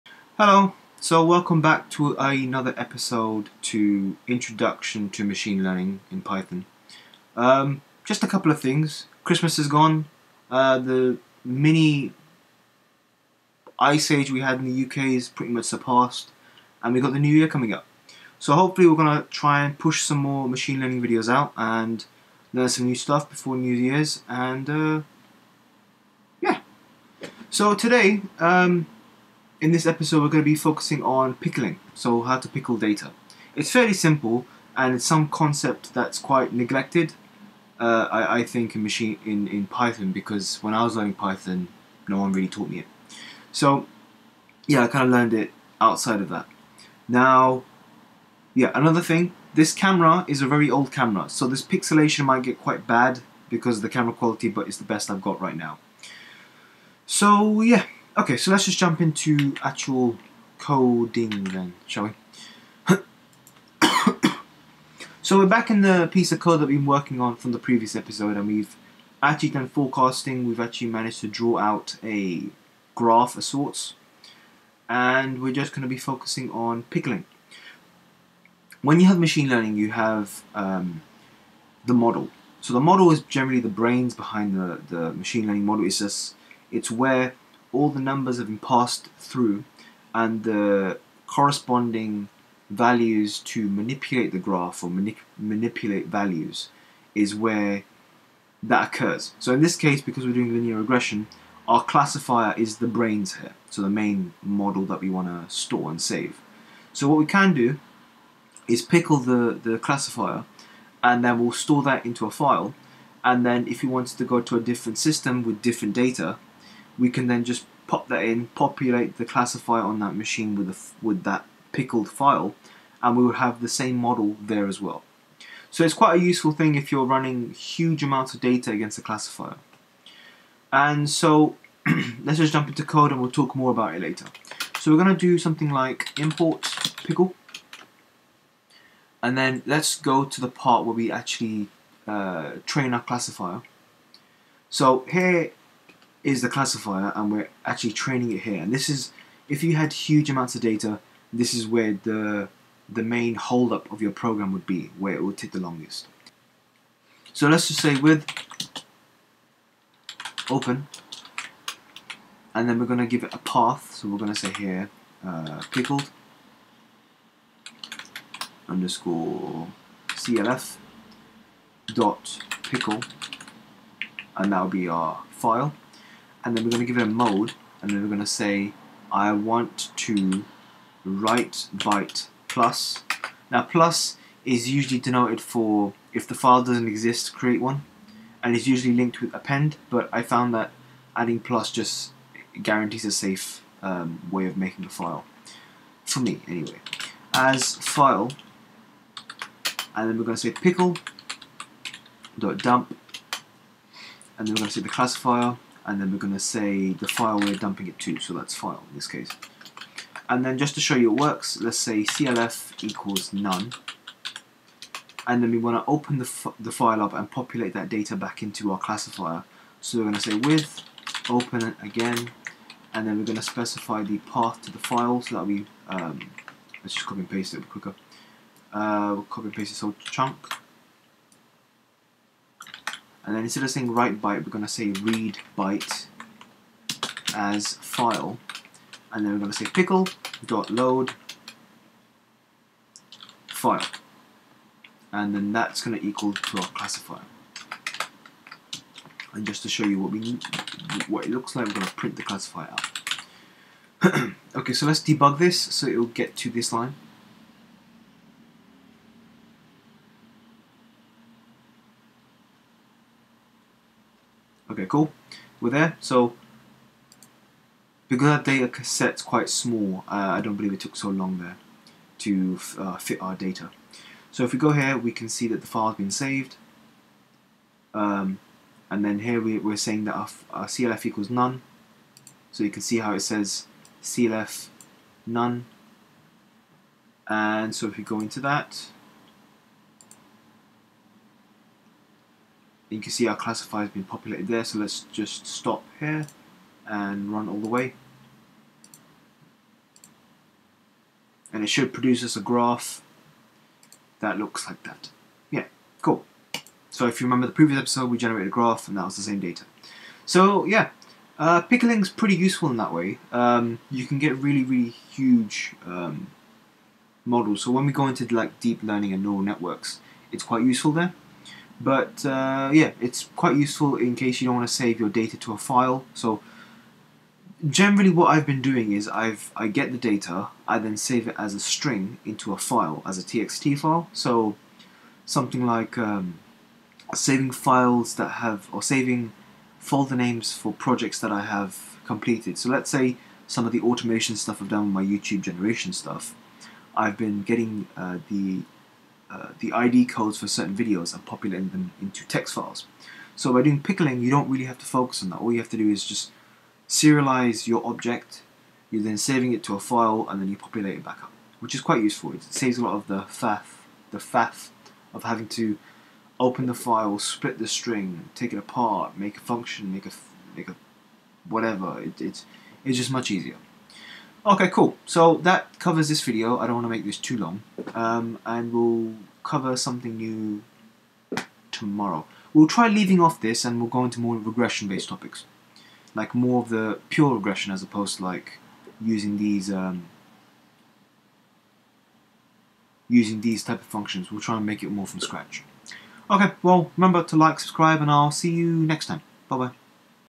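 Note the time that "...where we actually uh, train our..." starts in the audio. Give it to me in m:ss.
2:20.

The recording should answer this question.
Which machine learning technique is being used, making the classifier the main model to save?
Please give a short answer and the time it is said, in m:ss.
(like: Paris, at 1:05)
linear regression, at 1:40.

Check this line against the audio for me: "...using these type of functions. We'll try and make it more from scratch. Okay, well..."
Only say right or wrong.
right.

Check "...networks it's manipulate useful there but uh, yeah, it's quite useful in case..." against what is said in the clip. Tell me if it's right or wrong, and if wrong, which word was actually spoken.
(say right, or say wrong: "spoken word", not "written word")
wrong: "quite", not "manipulate".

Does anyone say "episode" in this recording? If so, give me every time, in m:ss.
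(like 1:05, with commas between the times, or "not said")
0:02, 0:29, 1:07, 5:07.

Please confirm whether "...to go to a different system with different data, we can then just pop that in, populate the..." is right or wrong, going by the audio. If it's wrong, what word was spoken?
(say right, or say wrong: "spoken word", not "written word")
right.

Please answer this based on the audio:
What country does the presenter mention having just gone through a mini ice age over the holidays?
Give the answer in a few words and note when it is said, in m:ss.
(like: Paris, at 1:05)
UK, at 0:14.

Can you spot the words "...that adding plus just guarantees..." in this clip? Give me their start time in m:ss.
3:10.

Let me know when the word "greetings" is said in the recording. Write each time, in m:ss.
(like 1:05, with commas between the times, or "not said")
not said.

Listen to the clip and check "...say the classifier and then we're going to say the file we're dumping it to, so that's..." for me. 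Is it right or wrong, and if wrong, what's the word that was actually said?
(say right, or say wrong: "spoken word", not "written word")
right.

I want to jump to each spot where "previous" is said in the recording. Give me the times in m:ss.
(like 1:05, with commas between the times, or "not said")
1:07, 5:07.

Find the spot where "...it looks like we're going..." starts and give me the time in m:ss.
4:11.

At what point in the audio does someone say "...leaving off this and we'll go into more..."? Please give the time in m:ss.
6:22.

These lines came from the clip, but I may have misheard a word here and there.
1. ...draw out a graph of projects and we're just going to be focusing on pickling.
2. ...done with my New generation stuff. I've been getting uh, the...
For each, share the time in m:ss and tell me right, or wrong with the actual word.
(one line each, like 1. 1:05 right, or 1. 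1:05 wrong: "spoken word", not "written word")
1. 1:11 wrong: "sorts", not "projects"
2. 5:44 wrong: "YouTube", not "New".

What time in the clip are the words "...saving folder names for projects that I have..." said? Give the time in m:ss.
5:38.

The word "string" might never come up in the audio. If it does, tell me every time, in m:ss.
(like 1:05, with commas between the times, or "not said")
5:31, 6:07.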